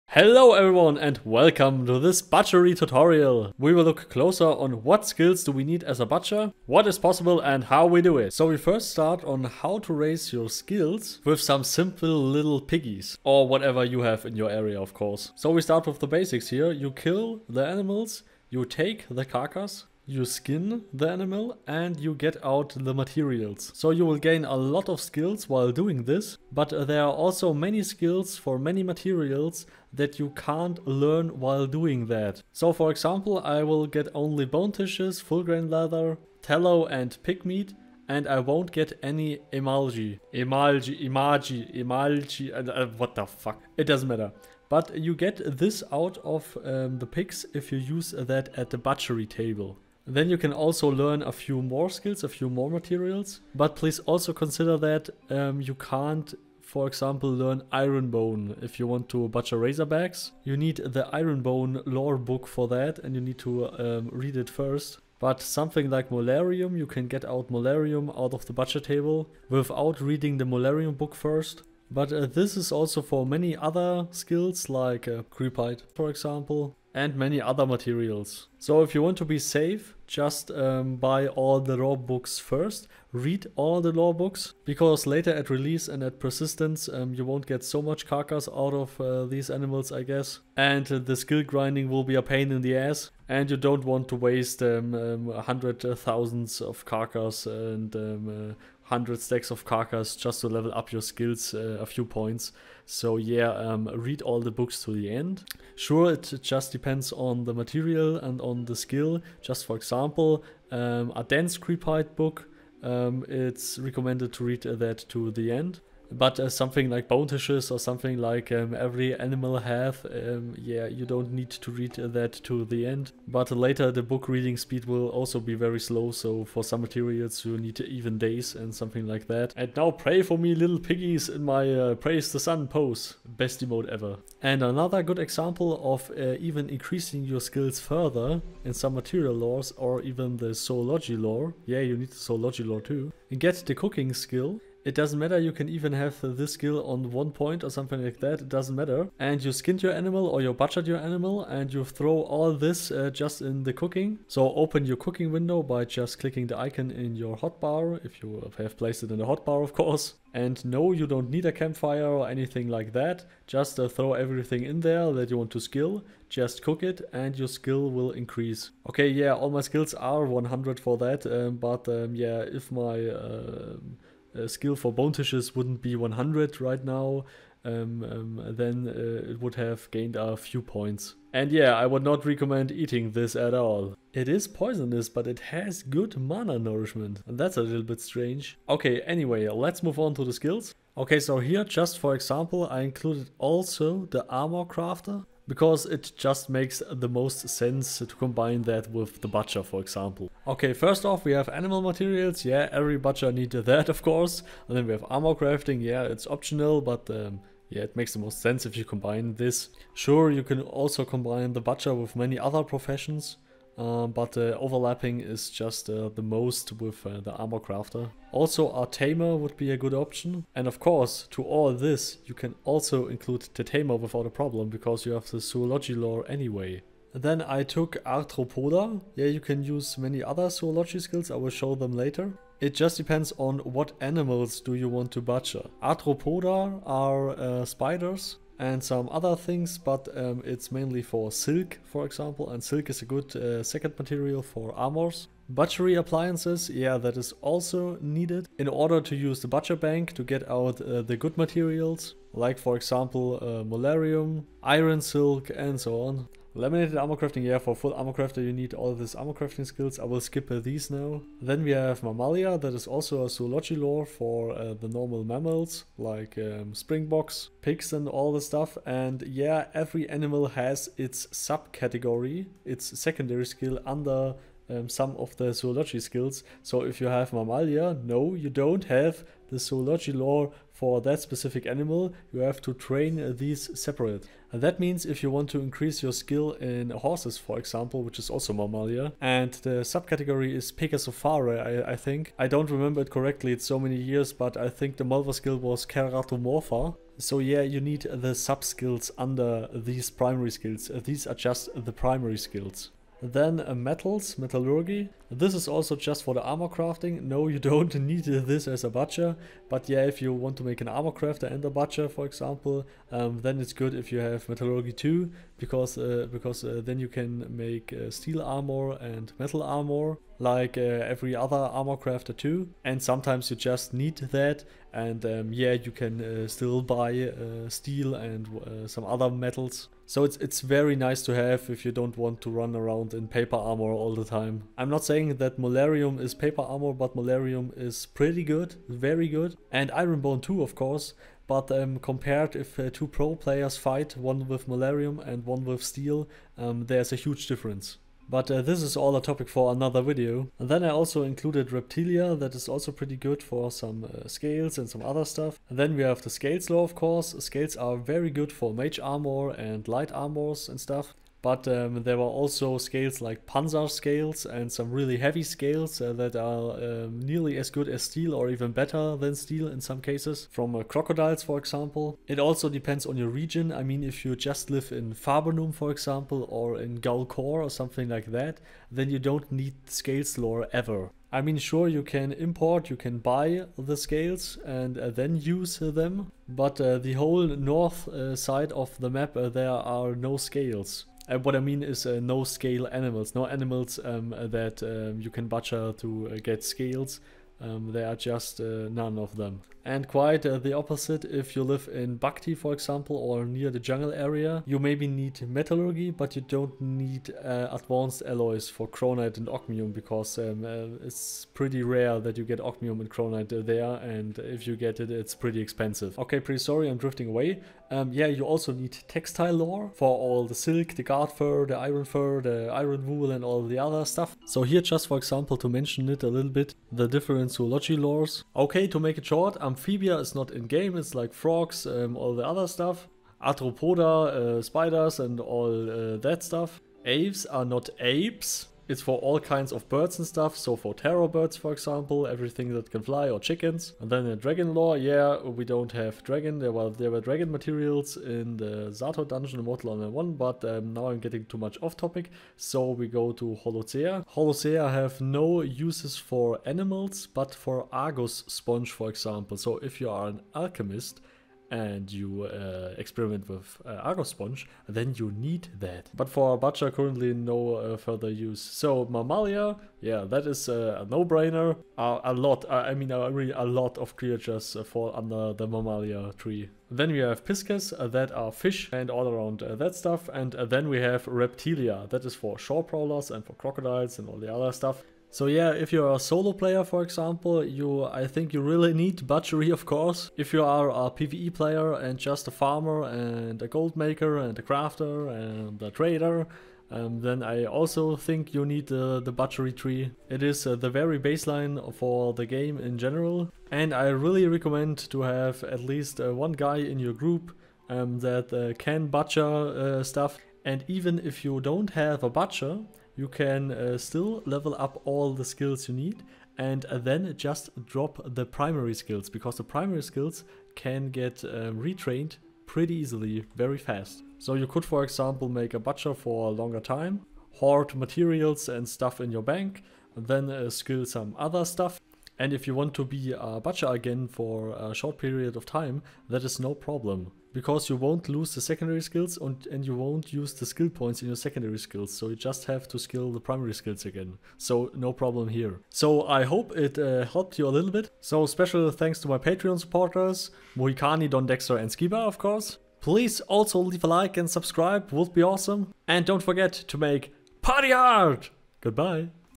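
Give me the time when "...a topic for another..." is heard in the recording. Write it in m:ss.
5:49.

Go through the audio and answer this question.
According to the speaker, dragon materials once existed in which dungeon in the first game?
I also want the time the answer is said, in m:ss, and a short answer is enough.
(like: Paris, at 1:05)
Zato, at 7:28.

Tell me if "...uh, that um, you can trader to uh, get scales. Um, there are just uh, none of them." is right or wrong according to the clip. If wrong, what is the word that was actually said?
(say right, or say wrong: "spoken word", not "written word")
wrong: "butcher", not "trader".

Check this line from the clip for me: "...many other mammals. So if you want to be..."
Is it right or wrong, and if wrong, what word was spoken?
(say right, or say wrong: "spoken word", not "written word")
wrong: "materials", not "mammals".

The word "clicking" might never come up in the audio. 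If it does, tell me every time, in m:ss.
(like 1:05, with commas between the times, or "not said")
2:36.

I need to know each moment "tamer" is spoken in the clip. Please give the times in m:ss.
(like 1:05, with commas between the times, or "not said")
3:38, 3:43.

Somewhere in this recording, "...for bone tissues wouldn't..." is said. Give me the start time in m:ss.
2:54.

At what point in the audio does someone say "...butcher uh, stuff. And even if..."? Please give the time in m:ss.
8:29.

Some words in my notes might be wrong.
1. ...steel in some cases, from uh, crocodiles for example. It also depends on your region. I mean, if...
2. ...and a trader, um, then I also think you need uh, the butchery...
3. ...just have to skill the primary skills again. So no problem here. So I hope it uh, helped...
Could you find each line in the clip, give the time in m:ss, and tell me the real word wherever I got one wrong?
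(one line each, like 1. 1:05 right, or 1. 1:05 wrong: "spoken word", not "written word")
1. 6:09 right
2. 8:15 right
3. 9:02 right.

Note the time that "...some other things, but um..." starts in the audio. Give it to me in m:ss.
3:58.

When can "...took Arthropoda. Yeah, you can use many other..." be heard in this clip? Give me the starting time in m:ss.
3:47.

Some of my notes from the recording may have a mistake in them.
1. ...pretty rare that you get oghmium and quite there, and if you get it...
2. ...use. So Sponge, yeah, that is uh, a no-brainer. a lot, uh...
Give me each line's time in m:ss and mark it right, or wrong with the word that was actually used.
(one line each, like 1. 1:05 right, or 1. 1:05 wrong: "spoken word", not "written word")
1. 6:51 wrong: "cronite", not "quite"
2. 7:48 wrong: "Mammalia", not "Sponge".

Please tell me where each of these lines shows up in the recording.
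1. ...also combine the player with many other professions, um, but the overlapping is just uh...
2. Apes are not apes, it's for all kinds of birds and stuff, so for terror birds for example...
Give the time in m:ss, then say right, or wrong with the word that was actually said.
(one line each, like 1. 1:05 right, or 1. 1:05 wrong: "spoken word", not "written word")
1. 3:30 wrong: "butcher", not "player"
2. 7:17 right.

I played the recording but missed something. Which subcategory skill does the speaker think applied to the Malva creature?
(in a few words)
Keratomorpha.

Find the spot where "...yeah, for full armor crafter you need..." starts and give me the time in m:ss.
4:17.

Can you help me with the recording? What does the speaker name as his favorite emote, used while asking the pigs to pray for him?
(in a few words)
Praise the sun.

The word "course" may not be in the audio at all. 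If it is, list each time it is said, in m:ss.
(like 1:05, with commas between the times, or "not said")
0:14, 2:39, 3:24, 3:40, 5:40, 5:56, 8:09, 9:12.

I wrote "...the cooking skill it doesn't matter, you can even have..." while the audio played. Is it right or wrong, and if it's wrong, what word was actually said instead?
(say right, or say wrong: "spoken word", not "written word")
right.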